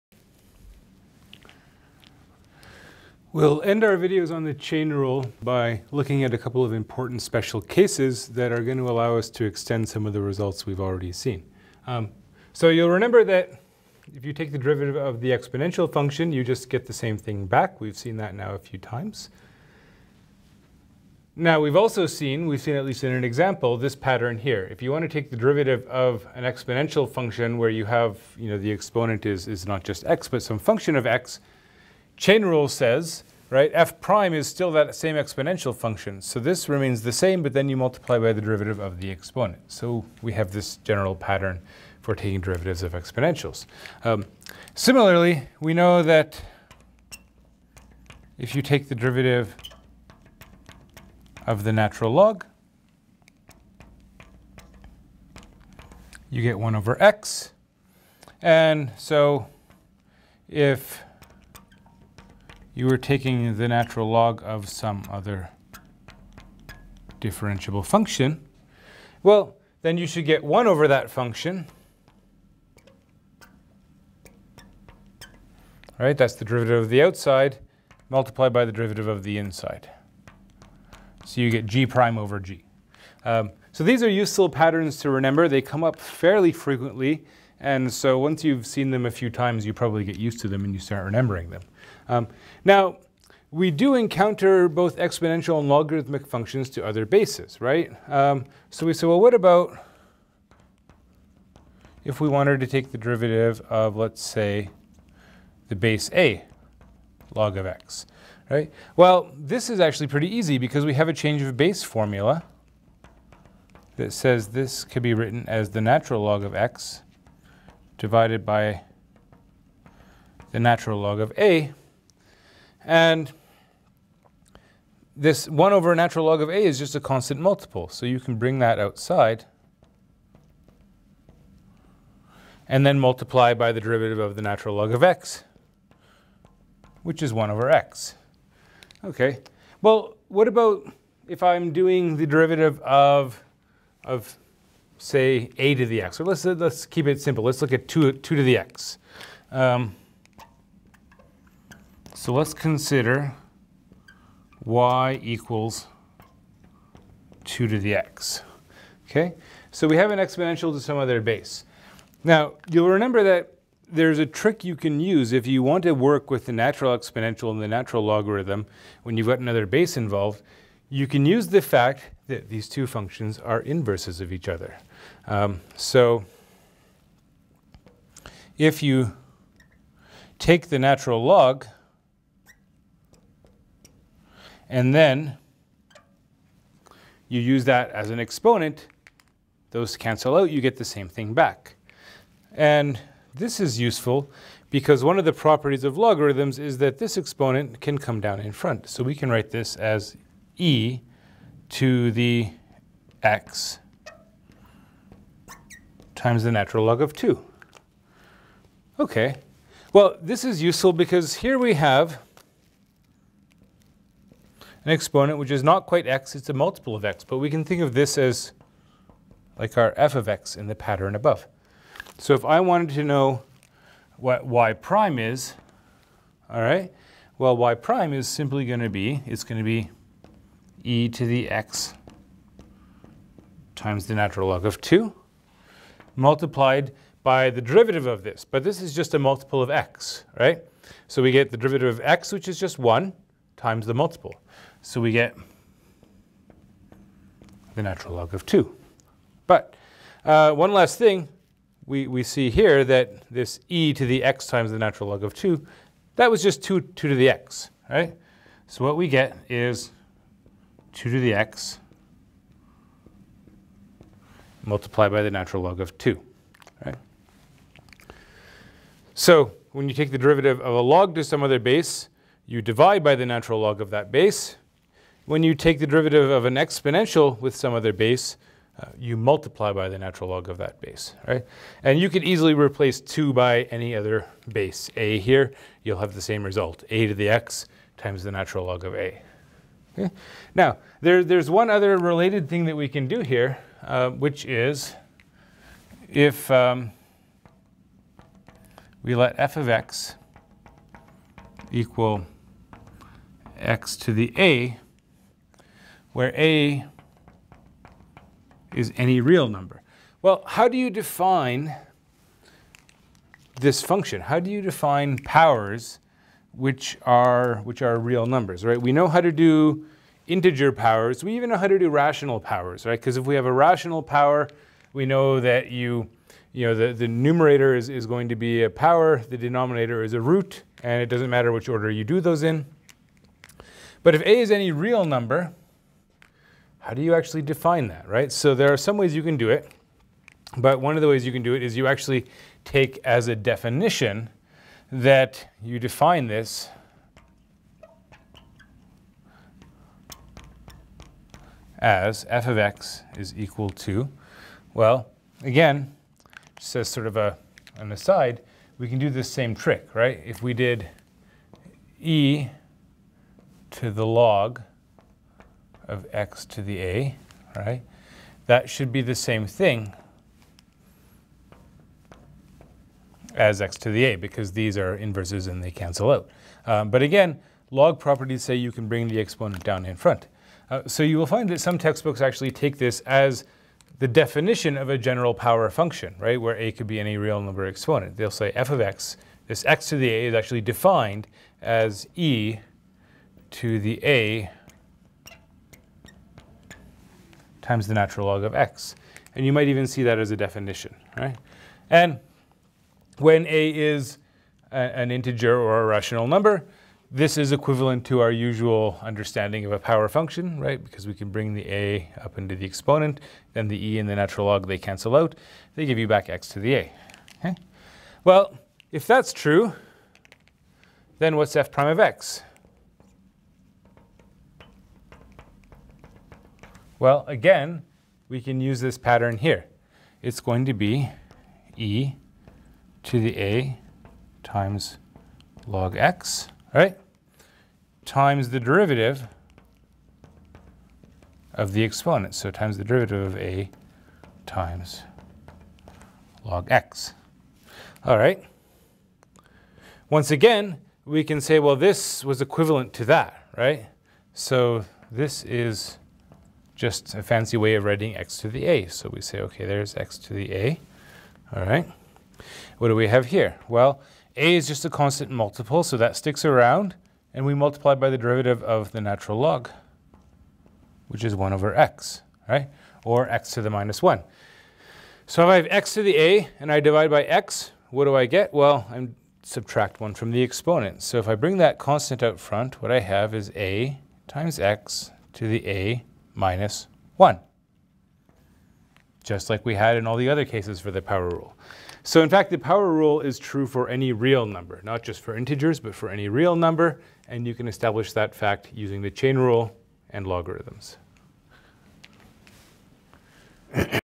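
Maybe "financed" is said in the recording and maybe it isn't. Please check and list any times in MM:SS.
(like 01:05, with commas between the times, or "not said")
not said.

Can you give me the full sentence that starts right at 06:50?
Because we can bring the a up into the exponent, then the e and the natural log, they cancel out.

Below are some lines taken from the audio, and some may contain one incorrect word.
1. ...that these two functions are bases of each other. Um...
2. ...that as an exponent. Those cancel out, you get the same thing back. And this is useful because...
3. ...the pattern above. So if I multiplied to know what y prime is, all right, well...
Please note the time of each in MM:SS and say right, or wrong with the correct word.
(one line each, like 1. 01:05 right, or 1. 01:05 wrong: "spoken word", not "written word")
1. 02:52 wrong: "inverses", not "bases"
2. 03:07 right
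3. 03:40 wrong: "wanted", not "multiplied".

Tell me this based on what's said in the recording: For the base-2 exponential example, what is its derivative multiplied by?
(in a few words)
the natural log of 2.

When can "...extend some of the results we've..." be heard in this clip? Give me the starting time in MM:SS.
00:09.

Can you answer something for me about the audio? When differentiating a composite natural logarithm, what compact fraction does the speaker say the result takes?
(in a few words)
g prime over g.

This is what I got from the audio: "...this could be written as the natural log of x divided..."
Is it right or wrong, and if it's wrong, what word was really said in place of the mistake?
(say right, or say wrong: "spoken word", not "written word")
right.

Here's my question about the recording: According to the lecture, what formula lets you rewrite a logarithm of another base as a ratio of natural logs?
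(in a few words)
change of base formula.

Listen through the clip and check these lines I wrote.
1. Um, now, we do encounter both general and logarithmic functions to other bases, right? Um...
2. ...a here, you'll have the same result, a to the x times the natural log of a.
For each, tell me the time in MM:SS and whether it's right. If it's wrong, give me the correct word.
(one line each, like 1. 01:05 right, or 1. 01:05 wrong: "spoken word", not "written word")
1. 01:32 wrong: "exponential", not "general"
2. 04:44 right.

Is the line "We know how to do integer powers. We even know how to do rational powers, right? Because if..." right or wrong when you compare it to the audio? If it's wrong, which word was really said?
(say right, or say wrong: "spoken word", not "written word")
right.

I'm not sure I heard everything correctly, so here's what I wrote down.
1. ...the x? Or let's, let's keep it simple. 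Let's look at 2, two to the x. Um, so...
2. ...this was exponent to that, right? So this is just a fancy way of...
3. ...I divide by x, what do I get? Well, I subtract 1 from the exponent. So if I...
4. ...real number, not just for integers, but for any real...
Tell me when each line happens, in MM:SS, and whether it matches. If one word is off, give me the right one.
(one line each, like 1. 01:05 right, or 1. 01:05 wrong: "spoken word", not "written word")
1. 02:25 right
2. 07:31 wrong: "equivalent", not "exponent"
3. 07:56 right
4. 08:14 right.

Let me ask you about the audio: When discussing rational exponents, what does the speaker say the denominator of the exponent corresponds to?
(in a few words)
a root.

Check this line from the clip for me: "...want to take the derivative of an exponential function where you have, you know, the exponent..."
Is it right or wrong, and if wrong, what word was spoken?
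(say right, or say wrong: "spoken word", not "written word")
right.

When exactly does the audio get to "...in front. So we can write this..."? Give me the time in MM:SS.
03:18.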